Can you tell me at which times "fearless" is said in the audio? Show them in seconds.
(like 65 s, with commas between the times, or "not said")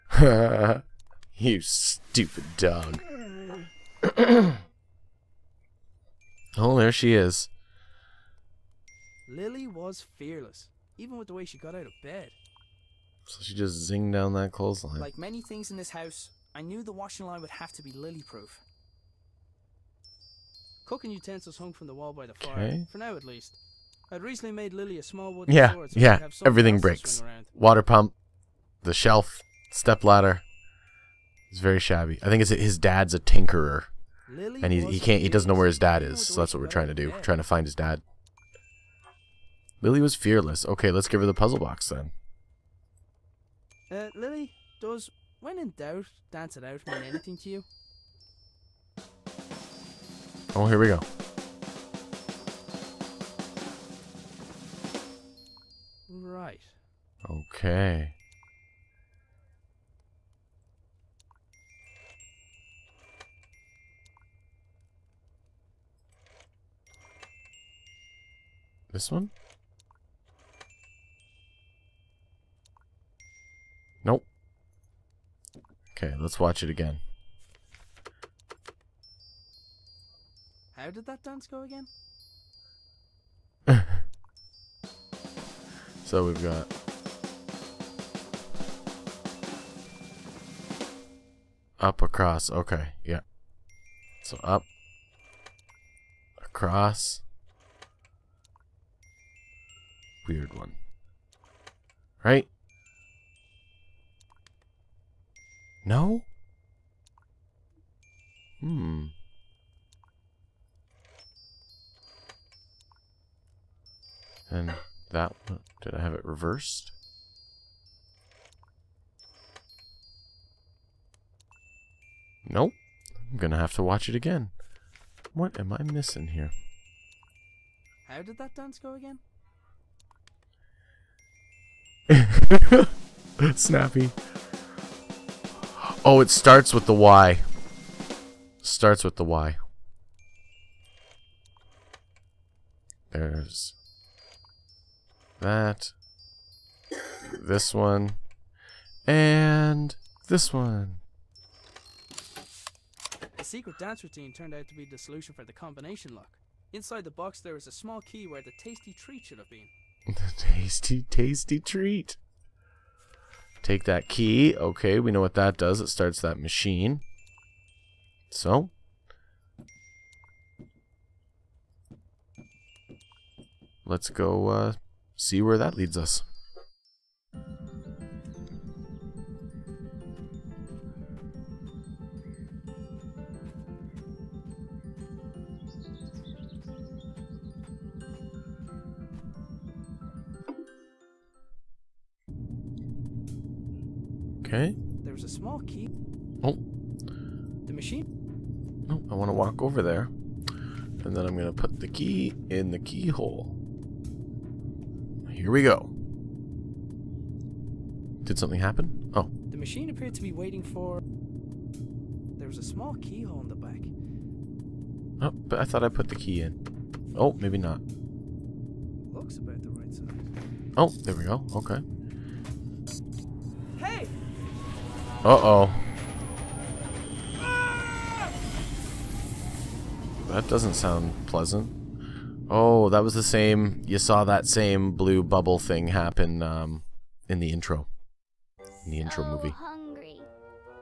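10 s, 40 s.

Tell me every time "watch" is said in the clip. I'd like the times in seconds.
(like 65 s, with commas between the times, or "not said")
76 s, 123 s.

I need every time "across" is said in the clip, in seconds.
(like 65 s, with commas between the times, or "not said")
92 s, 96 s.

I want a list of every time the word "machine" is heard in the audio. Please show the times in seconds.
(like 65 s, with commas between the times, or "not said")
166 s, 197 s, 209 s.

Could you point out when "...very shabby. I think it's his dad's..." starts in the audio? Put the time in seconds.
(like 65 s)
31 s.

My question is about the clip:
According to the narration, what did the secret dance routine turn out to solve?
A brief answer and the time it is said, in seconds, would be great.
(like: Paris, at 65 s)
the combination lock, at 155 s.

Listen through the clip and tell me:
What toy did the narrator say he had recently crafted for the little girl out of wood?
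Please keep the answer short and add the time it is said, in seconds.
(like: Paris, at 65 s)
sword, at 25 s.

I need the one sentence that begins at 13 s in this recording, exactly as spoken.
So she just zinged down that clothesline.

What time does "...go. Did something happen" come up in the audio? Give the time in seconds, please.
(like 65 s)
205 s.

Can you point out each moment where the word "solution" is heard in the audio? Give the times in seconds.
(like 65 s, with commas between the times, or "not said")
154 s.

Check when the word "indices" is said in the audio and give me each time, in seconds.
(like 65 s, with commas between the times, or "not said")
not said.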